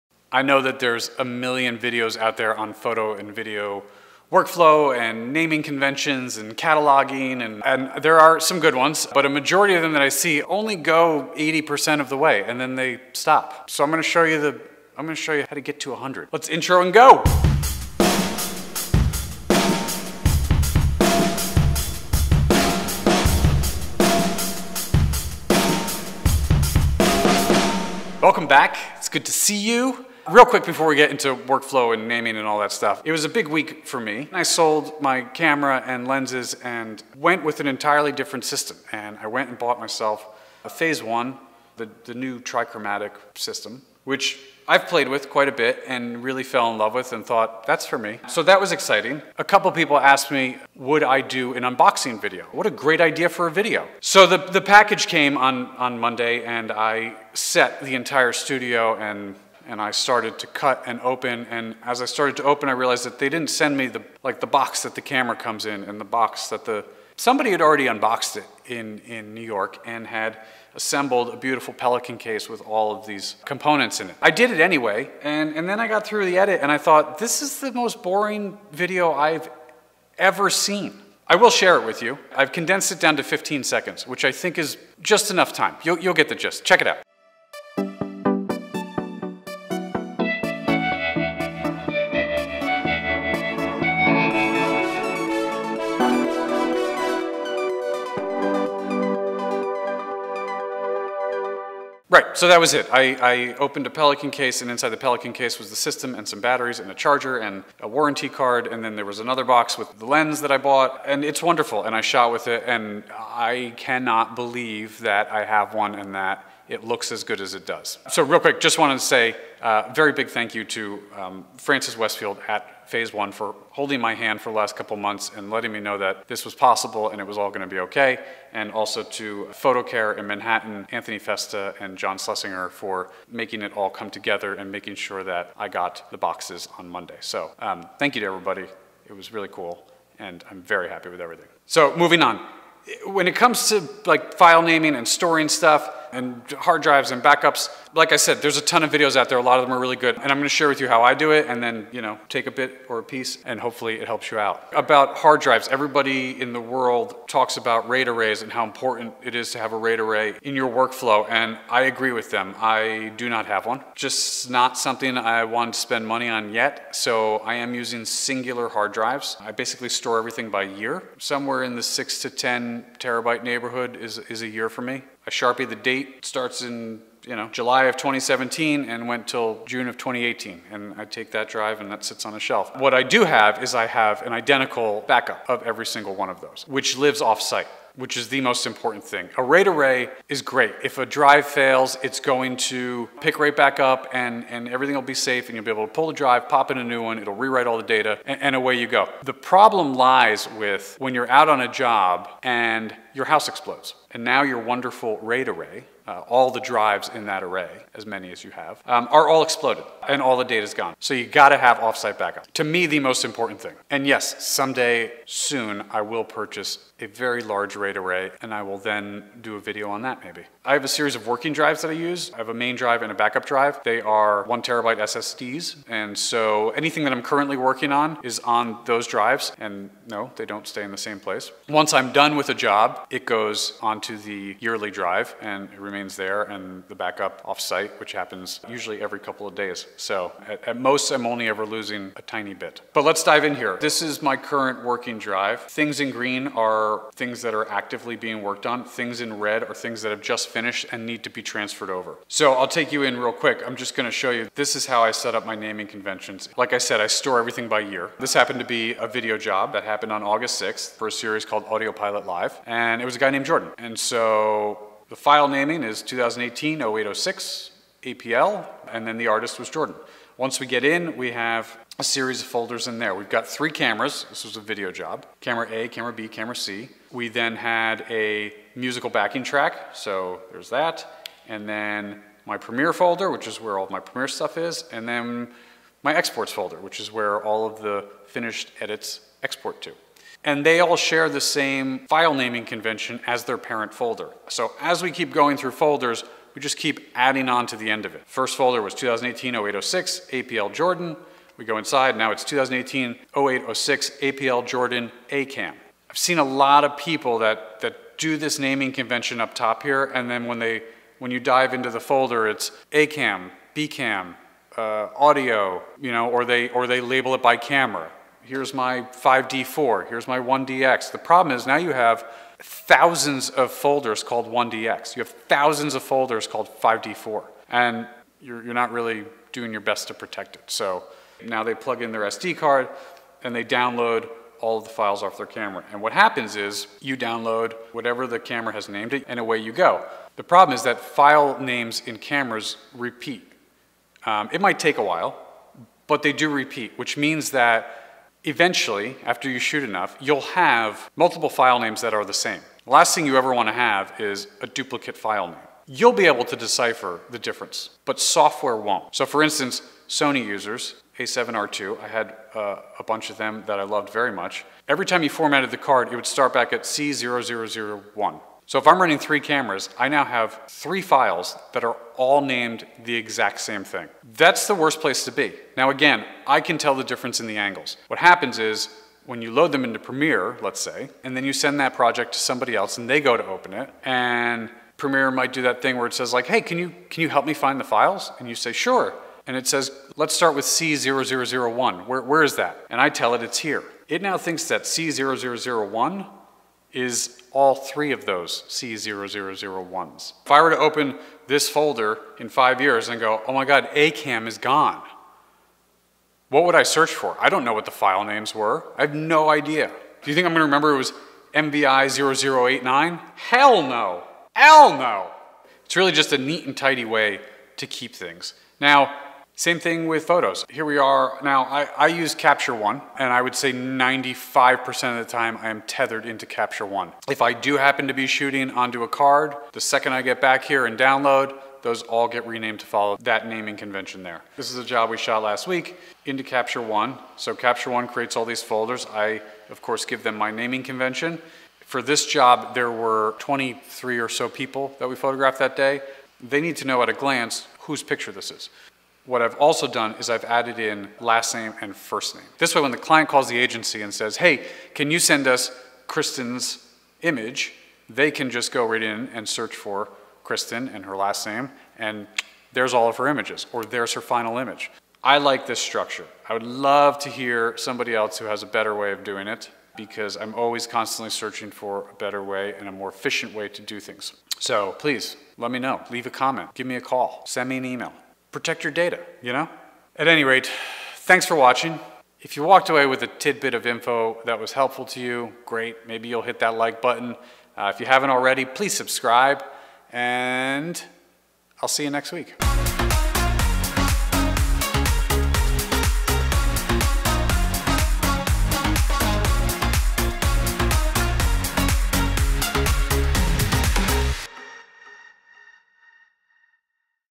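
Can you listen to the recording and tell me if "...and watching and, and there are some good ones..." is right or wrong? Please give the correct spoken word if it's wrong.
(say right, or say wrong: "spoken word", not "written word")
wrong: "cataloging", not "watching".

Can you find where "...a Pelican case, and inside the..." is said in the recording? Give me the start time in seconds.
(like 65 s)
103 s.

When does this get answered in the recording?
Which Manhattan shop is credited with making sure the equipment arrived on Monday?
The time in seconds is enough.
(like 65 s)
129 s.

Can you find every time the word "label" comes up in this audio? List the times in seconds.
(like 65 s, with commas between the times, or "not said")
316 s.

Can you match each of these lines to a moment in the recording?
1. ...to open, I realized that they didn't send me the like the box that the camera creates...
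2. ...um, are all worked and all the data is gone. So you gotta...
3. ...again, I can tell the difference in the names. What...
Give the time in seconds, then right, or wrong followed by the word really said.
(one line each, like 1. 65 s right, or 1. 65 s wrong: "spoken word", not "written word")
1. 62 s wrong: "comes", not "creates"
2. 208 s wrong: "exploded", not "worked"
3. 375 s wrong: "angles", not "names".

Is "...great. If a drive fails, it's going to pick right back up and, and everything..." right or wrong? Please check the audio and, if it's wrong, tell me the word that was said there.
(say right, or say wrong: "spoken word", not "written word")
right.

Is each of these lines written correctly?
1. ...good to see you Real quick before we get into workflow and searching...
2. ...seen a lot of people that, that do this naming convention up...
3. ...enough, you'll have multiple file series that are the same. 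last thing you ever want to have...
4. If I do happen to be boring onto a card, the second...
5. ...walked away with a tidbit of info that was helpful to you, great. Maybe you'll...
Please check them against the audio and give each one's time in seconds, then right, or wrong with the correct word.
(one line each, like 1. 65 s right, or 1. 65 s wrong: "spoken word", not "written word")
1. 29 s wrong: "naming", not "searching"
2. 306 s right
3. 349 s wrong: "names", not "series"
4. 427 s wrong: "shooting", not "boring"
5. 482 s right.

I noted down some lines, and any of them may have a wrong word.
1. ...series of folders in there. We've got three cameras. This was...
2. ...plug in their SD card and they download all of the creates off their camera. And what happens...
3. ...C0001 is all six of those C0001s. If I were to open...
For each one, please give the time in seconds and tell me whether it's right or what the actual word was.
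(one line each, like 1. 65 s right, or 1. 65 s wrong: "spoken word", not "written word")
1. 272 s right
2. 331 s wrong: "files", not "creates"
3. 394 s wrong: "three", not "six".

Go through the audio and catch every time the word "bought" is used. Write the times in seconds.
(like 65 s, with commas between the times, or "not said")
39 s, 110 s.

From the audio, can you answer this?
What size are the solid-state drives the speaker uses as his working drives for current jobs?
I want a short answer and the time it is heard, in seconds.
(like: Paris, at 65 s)
1 terabyte, at 224 s.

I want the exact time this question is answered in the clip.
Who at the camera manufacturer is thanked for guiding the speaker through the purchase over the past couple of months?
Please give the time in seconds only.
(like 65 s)
121 s.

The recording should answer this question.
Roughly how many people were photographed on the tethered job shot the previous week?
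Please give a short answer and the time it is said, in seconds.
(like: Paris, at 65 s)
23, at 443 s.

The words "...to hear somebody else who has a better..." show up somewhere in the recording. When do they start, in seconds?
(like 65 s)
467 s.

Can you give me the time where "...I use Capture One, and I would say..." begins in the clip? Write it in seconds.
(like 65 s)
421 s.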